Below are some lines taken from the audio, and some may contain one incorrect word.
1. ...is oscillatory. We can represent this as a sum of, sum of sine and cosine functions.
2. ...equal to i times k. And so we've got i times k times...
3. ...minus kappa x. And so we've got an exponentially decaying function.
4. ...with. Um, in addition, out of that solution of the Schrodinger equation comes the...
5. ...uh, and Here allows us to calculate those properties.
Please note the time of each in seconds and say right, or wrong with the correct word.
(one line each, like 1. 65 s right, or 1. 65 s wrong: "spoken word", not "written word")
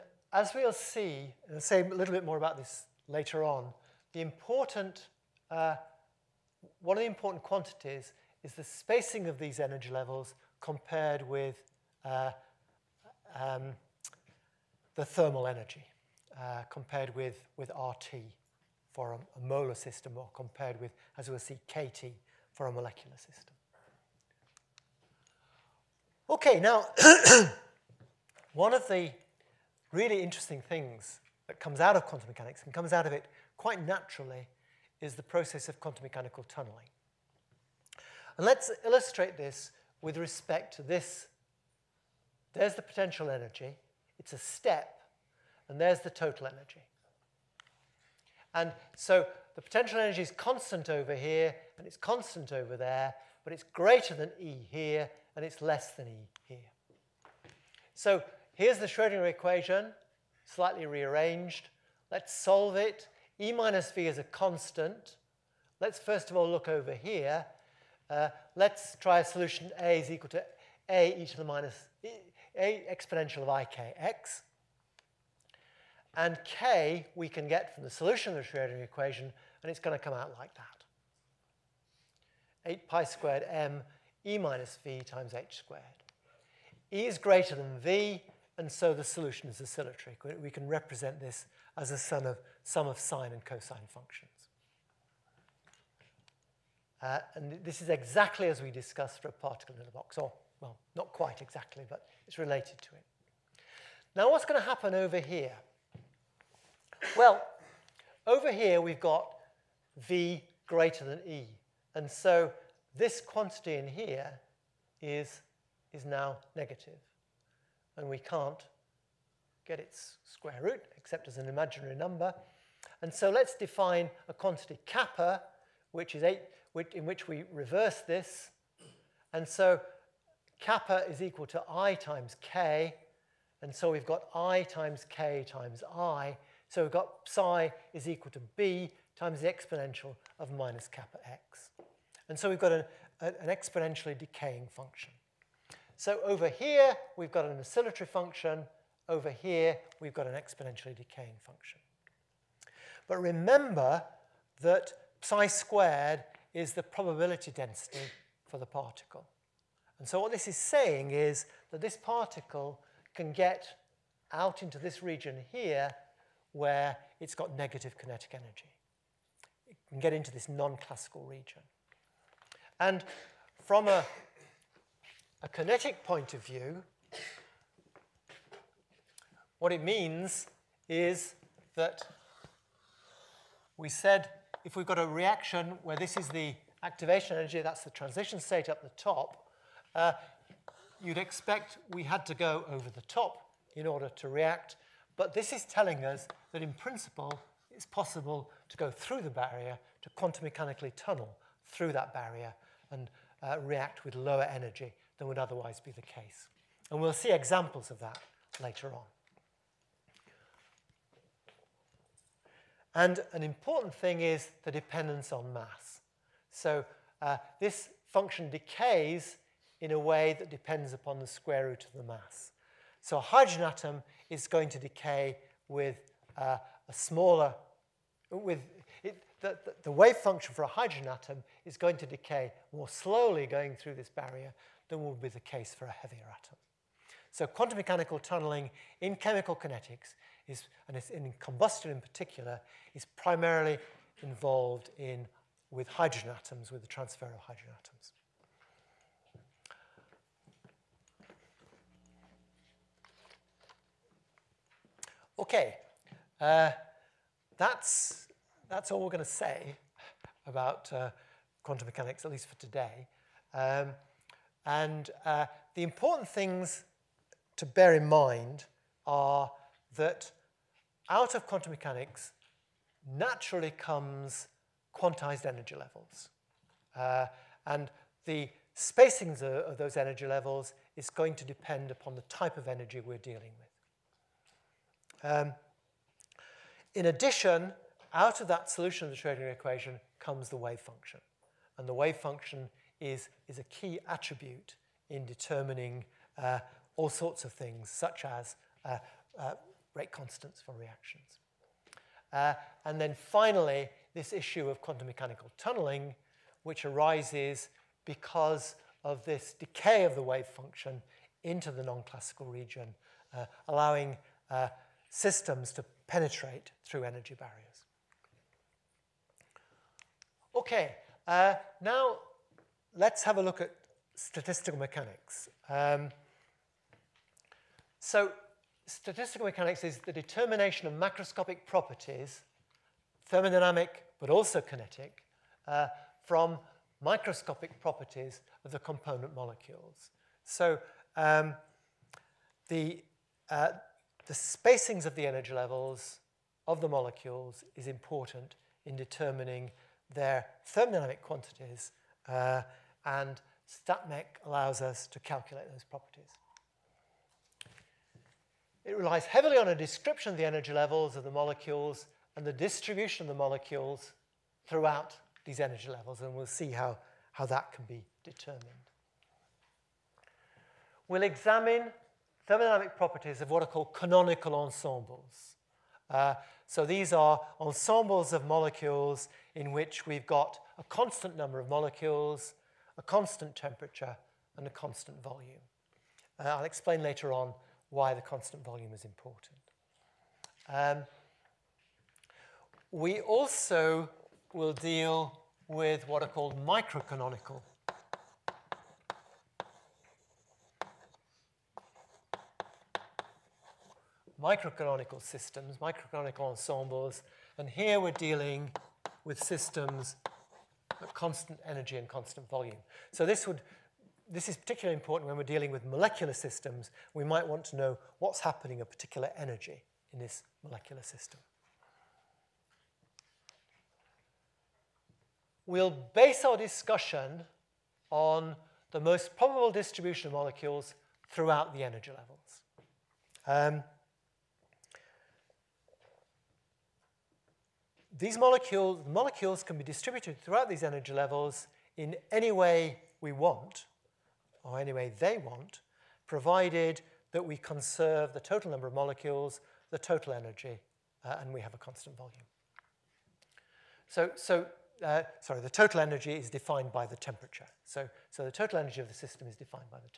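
1. 89 s right
2. 131 s right
3. 140 s right
4. 285 s right
5. 352 s wrong: "StatMech", not "Here".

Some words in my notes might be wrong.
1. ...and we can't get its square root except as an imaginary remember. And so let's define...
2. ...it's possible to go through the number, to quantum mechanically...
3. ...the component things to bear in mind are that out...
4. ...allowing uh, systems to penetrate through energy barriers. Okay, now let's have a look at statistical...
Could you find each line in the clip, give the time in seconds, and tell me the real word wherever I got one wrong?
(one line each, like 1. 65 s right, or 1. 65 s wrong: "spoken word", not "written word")
1. 117 s wrong: "number", not "remember"
2. 197 s wrong: "barrier", not "number"
3. 265 s wrong: "important", not "component"
4. 313 s right.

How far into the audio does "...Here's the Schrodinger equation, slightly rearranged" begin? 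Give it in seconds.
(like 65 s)
58 s.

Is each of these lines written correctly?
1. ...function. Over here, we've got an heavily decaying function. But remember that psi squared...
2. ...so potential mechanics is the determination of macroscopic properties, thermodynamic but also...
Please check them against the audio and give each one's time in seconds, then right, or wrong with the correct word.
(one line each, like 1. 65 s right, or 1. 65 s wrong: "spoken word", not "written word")
1. 148 s wrong: "exponentially", not "heavily"
2. 327 s wrong: "statistical", not "potential".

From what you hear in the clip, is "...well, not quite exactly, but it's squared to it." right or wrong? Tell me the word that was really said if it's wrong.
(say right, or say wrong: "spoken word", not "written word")
wrong: "related", not "squared".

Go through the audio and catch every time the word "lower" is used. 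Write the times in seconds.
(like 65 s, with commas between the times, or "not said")
204 s.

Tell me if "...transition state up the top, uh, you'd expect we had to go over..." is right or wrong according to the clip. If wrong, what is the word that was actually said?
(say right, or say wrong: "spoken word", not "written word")
right.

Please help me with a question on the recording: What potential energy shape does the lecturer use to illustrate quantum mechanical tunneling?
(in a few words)
A step.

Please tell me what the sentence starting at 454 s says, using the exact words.
So, so uh, sorry, the total energy is defined by the temperature.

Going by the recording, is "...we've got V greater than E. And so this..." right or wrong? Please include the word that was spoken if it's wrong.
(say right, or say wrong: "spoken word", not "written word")
right.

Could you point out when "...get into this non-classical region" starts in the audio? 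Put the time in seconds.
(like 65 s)
169 s.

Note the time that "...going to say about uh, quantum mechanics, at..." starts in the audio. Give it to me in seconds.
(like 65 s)
259 s.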